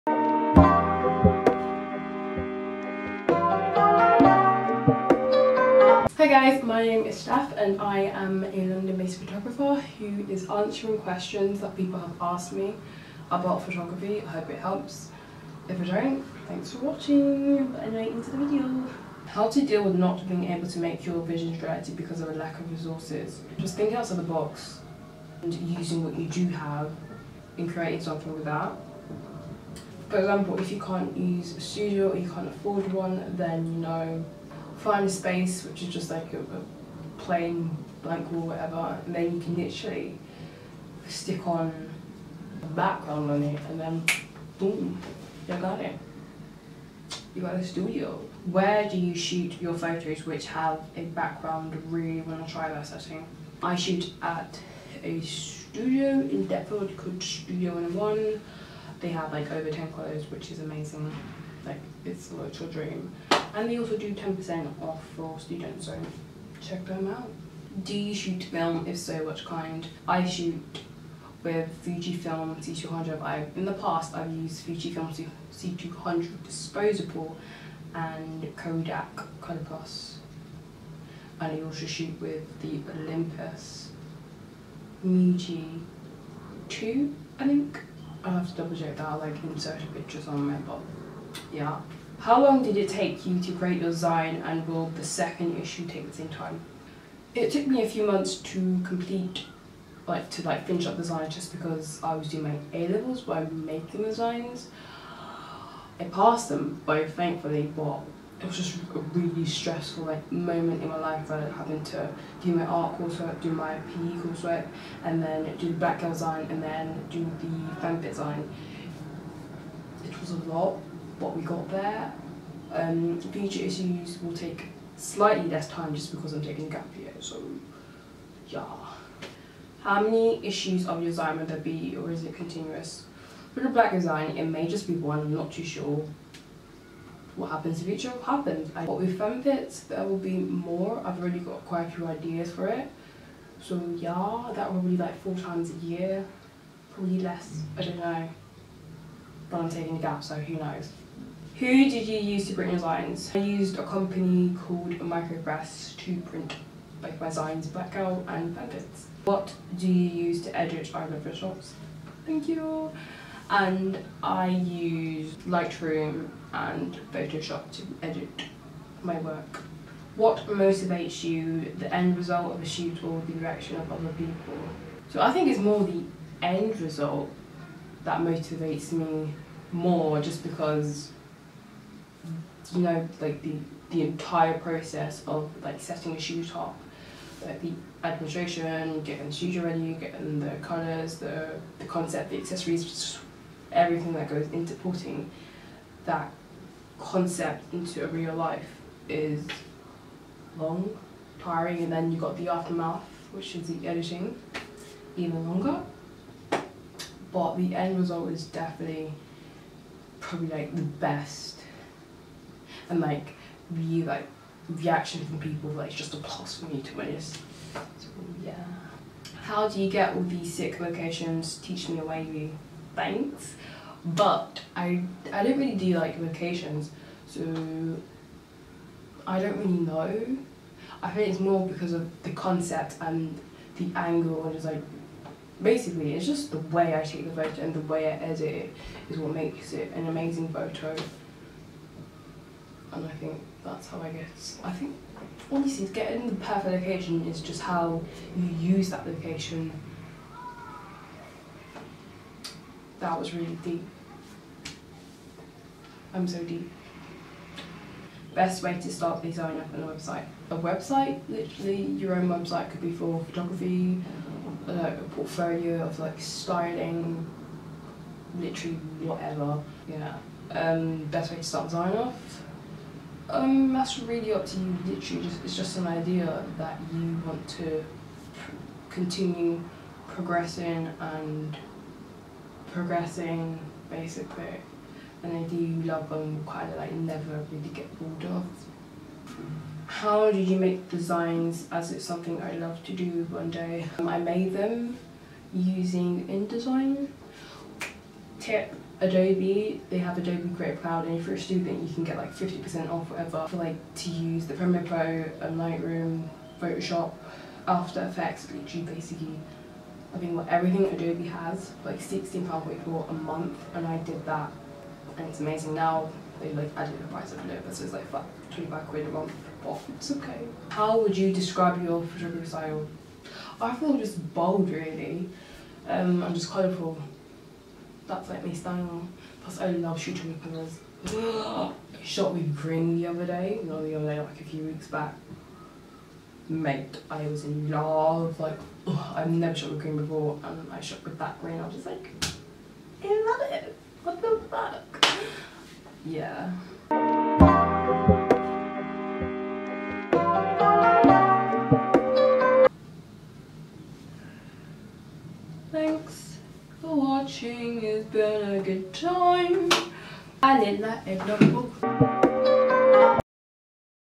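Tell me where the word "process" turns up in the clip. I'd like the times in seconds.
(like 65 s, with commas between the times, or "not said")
184 s.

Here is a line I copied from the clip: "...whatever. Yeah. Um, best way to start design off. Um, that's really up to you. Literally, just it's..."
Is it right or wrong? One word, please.
right.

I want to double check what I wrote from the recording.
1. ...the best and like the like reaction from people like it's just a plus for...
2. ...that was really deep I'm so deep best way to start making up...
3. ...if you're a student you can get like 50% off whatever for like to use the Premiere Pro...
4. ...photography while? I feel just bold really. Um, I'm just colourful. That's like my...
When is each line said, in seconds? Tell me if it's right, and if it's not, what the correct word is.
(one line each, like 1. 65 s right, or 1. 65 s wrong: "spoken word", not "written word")
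1. 210 s right
2. 252 s wrong: "designing", not "making"
3. 301 s right
4. 322 s wrong: "style", not "while".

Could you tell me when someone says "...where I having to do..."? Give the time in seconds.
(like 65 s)
111 s.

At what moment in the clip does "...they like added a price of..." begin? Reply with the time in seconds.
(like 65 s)
316 s.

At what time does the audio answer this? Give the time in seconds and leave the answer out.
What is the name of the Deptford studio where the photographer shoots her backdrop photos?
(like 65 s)
57 s.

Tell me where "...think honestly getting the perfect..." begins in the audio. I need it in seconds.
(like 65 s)
244 s.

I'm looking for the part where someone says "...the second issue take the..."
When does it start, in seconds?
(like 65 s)
94 s.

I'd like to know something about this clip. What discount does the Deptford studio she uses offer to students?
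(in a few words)
10%.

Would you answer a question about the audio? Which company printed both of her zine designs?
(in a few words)
Micropress.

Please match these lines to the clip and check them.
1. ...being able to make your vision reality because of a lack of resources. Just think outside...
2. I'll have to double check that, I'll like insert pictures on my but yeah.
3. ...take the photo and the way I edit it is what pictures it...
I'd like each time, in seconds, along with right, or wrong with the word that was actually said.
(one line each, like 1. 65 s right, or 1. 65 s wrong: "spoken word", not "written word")
1. 20 s right
2. 88 s right
3. 237 s wrong: "makes", not "pictures".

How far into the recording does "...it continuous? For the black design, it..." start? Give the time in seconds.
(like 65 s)
132 s.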